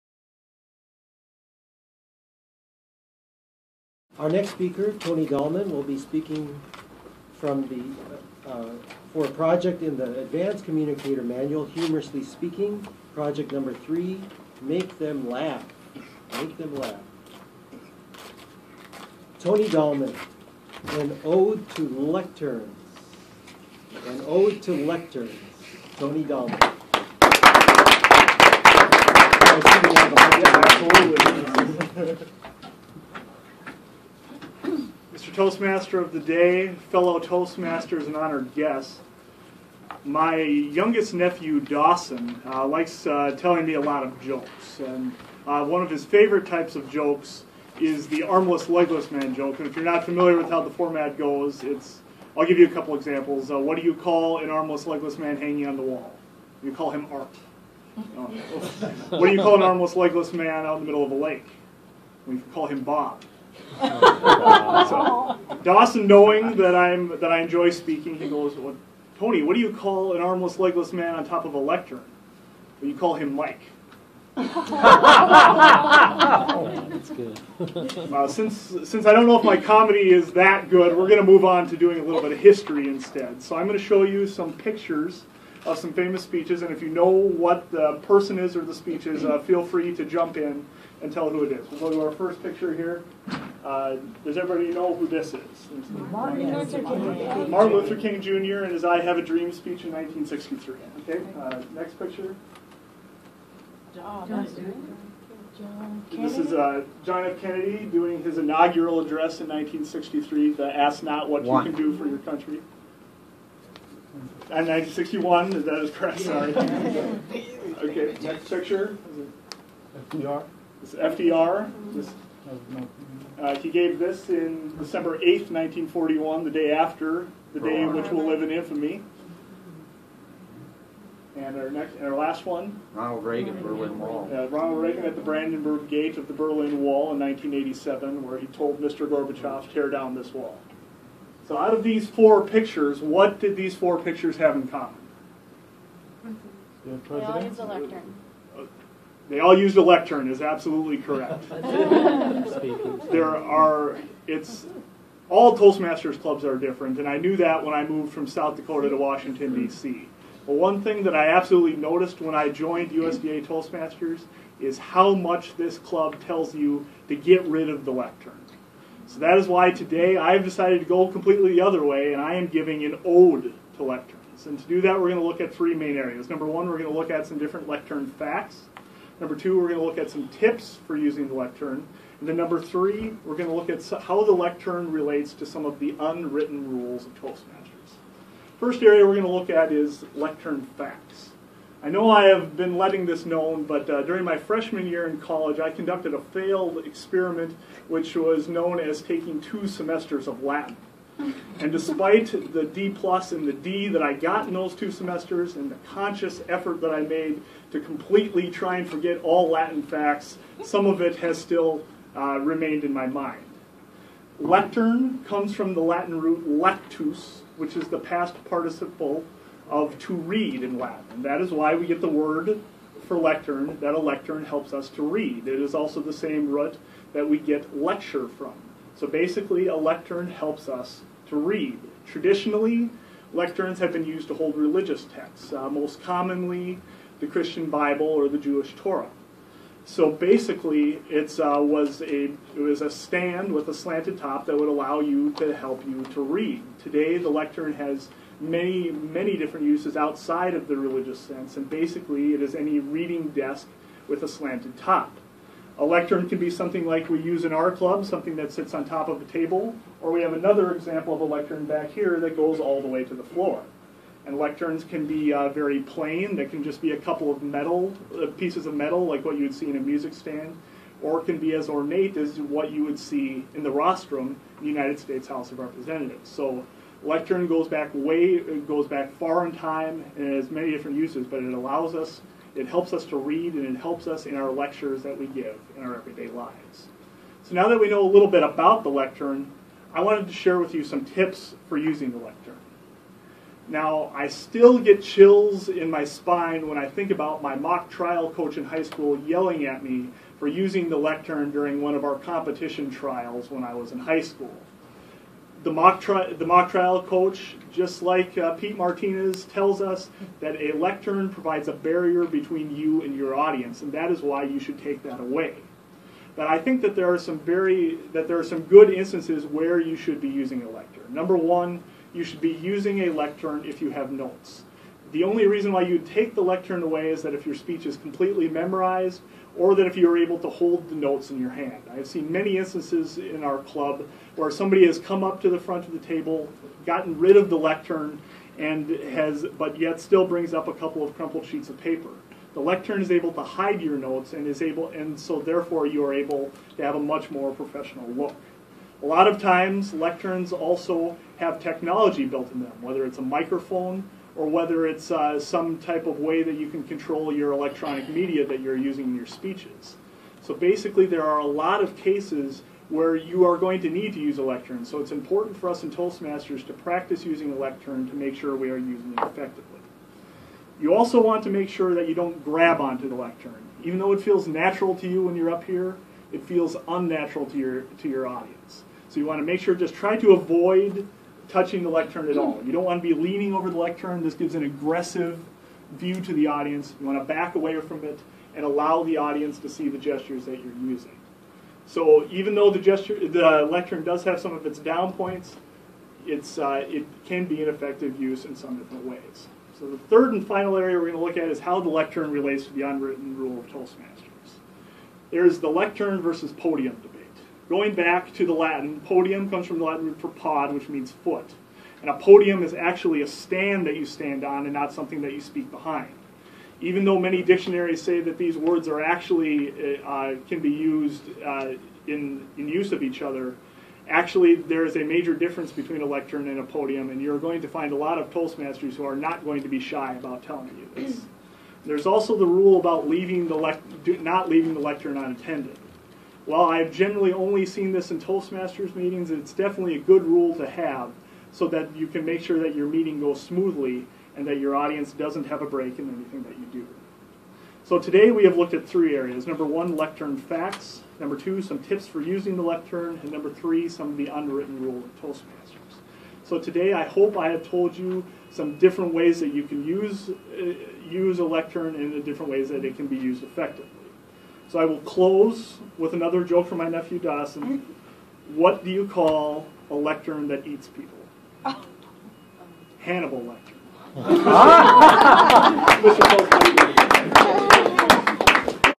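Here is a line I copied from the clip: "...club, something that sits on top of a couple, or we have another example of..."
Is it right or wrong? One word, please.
wrong.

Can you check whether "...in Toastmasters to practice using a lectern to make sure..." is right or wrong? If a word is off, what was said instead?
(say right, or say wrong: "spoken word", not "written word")
right.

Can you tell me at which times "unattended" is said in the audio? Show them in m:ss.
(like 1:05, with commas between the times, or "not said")
7:15.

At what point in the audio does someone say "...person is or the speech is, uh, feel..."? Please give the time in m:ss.
1:28.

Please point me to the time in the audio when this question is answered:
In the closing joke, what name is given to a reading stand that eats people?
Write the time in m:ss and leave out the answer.
7:52.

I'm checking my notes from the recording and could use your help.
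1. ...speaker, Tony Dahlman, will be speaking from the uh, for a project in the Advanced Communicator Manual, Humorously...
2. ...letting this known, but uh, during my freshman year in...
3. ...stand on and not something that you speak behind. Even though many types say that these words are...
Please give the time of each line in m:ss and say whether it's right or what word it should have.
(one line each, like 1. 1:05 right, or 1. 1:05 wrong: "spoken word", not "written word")
1. 0:04 right
2. 3:12 right
3. 6:54 wrong: "dictionaries", not "types".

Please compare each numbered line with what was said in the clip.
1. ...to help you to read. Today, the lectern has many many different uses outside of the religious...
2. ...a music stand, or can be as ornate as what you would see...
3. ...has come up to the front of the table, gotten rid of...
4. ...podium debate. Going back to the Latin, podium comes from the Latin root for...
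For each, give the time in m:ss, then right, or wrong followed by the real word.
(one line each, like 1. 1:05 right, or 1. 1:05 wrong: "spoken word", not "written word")
1. 4:05 right
2. 4:29 right
3. 5:34 right
4. 6:46 right.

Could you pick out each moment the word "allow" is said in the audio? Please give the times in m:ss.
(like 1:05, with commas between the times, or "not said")
4:04, 4:41, 6:28.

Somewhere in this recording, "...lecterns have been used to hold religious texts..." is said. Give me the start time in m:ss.
3:53.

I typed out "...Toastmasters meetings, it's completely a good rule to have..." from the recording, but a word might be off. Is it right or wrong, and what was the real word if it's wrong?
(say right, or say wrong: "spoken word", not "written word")
wrong: "definitely", not "completely".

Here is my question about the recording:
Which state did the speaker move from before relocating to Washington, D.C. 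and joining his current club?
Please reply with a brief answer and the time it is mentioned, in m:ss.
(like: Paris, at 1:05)
South Dakota, at 2:38.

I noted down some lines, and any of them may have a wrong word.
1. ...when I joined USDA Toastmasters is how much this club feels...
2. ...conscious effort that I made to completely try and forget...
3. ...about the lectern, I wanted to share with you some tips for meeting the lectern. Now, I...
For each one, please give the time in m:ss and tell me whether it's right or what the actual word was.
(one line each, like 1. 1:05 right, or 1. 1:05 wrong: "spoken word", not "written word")
1. 2:42 wrong: "tells", not "feels"
2. 3:25 right
3. 4:48 wrong: "using", not "meeting".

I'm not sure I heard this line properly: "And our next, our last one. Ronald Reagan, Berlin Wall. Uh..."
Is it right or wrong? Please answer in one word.
right.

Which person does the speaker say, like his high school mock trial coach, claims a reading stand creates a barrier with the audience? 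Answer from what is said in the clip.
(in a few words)
Pete Martinez.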